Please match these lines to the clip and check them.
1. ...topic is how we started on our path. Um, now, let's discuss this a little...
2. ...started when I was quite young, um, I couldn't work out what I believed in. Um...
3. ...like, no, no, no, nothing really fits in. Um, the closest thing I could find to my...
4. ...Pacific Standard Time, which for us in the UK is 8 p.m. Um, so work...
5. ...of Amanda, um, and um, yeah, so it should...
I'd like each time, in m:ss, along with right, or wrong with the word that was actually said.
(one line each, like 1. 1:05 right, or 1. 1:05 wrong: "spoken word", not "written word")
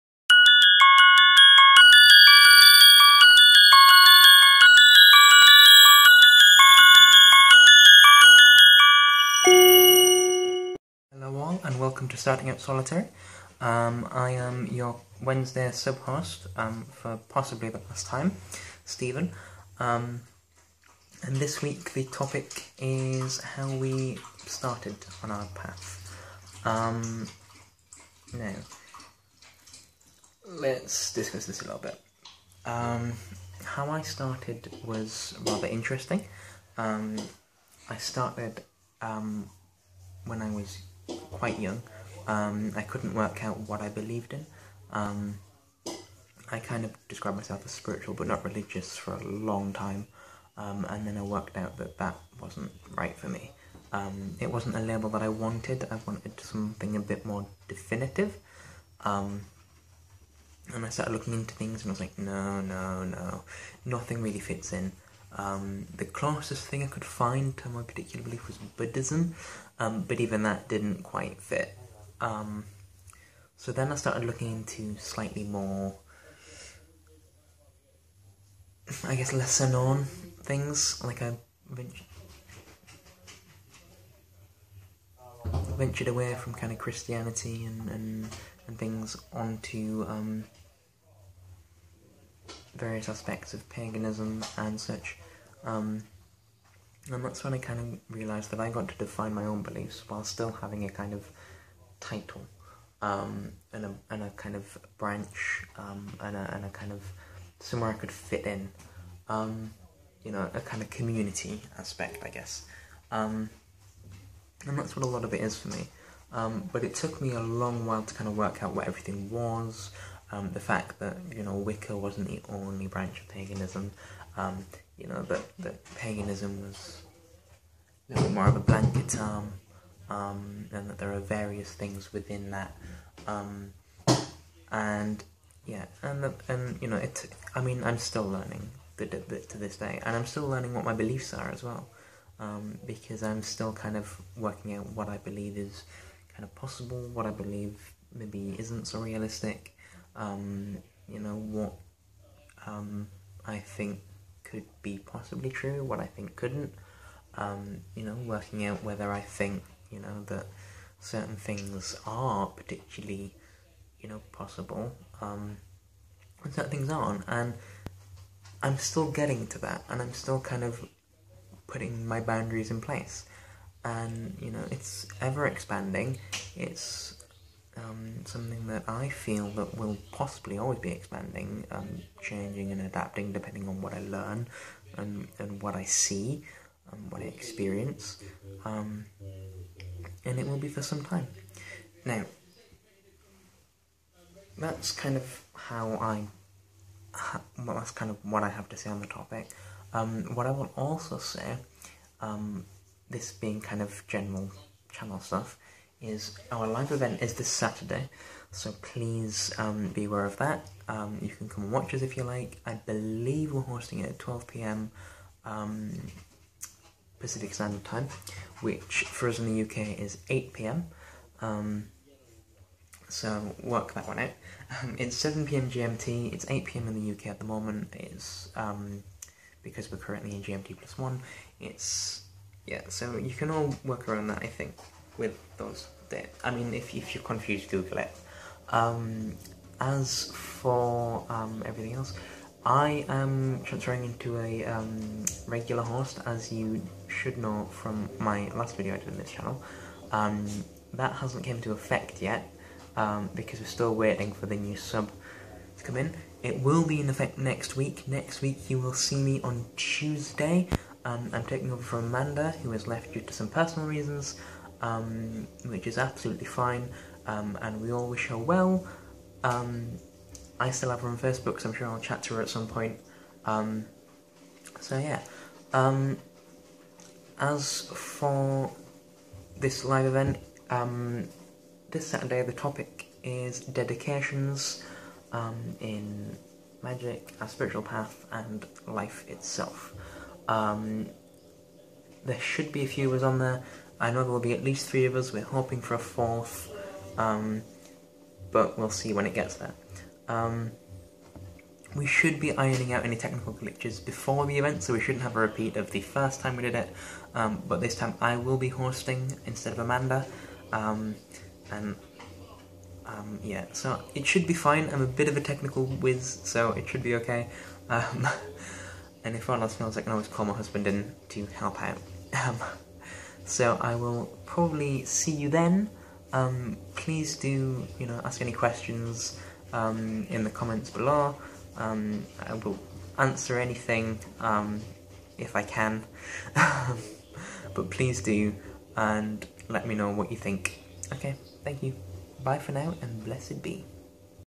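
1. 0:22 right
2. 0:37 right
3. 1:01 right
4. 3:37 right
5. 5:09 right.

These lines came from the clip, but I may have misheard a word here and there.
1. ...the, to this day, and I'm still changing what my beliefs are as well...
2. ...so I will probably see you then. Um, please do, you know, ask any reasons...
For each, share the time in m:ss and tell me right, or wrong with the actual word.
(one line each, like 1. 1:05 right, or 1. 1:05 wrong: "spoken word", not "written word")
1. 2:19 wrong: "learning", not "changing"
2. 5:23 wrong: "questions", not "reasons".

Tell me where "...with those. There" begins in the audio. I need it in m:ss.
3:55.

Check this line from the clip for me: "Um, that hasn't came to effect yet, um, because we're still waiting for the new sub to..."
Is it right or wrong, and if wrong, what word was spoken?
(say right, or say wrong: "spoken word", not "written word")
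right.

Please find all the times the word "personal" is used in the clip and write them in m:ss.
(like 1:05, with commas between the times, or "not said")
4:23.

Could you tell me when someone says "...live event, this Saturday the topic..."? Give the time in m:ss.
4:39.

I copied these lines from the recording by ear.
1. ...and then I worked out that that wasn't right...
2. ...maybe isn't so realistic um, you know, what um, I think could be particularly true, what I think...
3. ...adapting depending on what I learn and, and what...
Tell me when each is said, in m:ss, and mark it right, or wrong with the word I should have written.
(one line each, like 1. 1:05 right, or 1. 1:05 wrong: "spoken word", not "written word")
1. 0:50 right
2. 2:28 wrong: "possibly", not "particularly"
3. 3:02 right.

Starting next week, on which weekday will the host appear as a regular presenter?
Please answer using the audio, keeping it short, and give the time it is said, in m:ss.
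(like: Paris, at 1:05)
Tuesday, at 4:19.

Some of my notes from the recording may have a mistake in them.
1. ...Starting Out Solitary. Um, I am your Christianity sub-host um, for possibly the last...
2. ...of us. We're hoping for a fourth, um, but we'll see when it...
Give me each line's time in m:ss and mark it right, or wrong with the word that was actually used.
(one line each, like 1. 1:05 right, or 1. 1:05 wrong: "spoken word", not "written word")
1. 0:12 wrong: "Wednesday", not "Christianity"
2. 4:55 right.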